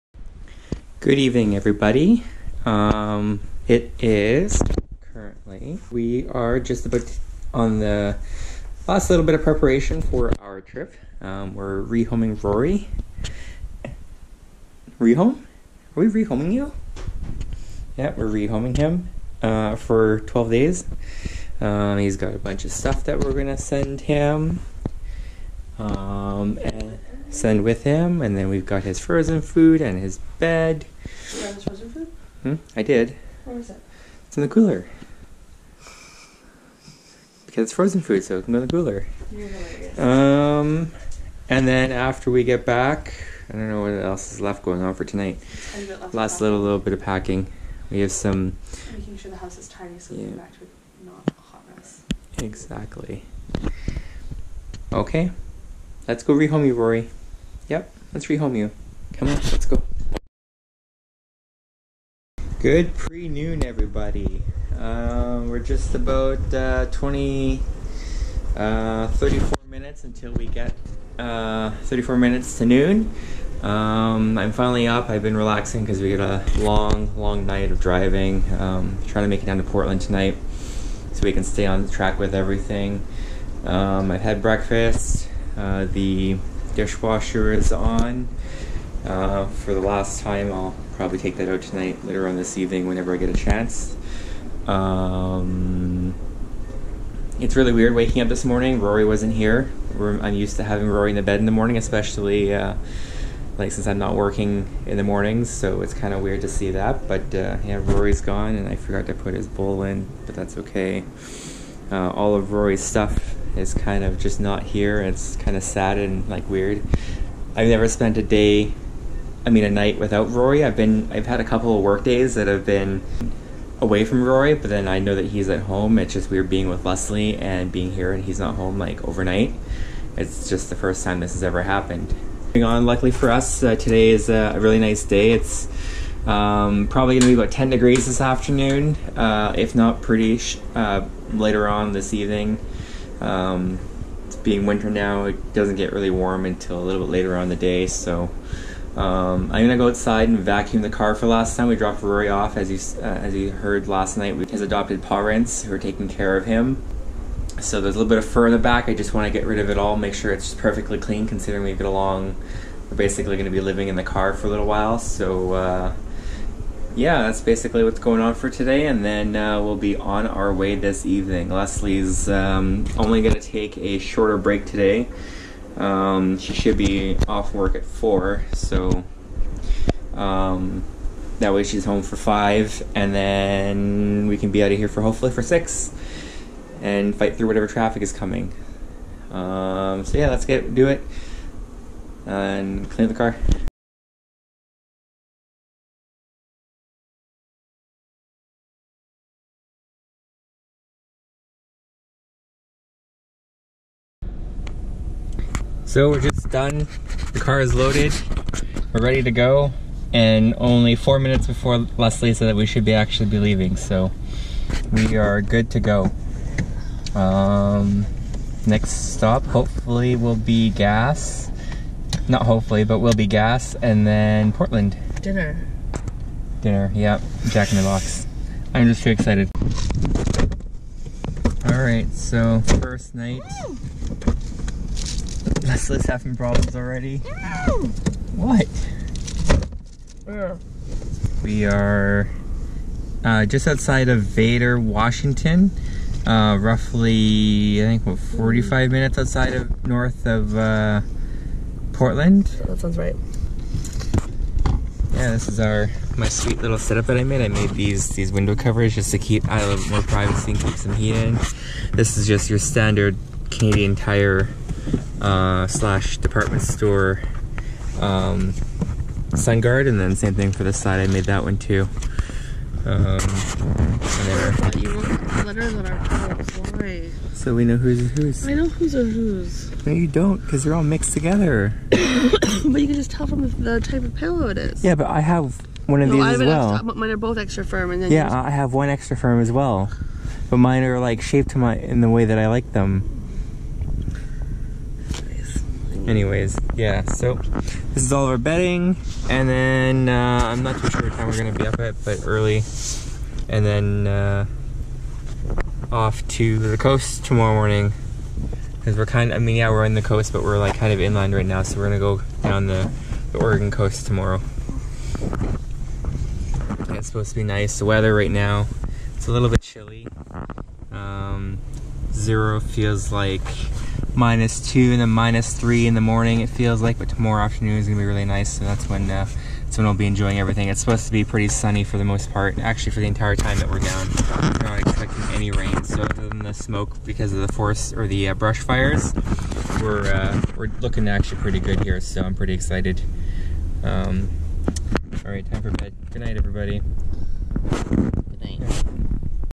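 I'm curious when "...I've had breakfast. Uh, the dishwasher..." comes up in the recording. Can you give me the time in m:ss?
1:24.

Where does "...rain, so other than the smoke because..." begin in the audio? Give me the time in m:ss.
5:35.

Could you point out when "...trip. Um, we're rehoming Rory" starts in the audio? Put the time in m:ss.
0:10.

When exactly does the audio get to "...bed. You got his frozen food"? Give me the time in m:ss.
0:30.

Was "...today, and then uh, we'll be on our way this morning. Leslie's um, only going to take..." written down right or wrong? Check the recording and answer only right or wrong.
wrong.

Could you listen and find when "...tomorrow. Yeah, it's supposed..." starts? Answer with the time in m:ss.
5:14.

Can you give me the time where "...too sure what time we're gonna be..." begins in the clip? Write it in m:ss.
5:00.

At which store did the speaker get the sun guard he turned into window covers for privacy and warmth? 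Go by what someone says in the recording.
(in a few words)
Canadian Tire.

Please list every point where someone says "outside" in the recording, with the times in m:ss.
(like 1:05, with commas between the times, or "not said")
2:29, 4:03, 4:09.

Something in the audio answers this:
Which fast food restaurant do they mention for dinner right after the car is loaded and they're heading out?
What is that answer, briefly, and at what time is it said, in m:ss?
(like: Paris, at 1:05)
Jack in the Box, at 3:47.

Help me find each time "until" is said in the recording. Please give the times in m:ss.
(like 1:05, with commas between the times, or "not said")
1:10, 2:26.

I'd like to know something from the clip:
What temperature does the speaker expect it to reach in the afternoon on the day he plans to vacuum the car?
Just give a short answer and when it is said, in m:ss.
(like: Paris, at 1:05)
10 degrees, at 2:17.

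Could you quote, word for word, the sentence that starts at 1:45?
So it's kind of weird to see that.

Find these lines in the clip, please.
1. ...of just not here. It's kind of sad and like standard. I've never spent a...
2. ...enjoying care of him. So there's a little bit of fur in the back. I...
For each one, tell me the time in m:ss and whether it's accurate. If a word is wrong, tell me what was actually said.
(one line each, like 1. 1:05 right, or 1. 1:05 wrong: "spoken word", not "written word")
1. 1:54 wrong: "weird", not "standard"
2. 2:35 wrong: "taking", not "enjoying".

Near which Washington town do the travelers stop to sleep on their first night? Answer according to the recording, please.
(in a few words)
Vader.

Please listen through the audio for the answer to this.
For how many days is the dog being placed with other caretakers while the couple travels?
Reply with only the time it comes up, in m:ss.
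0:20.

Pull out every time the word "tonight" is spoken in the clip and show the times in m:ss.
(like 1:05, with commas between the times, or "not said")
0:45, 1:20, 1:31.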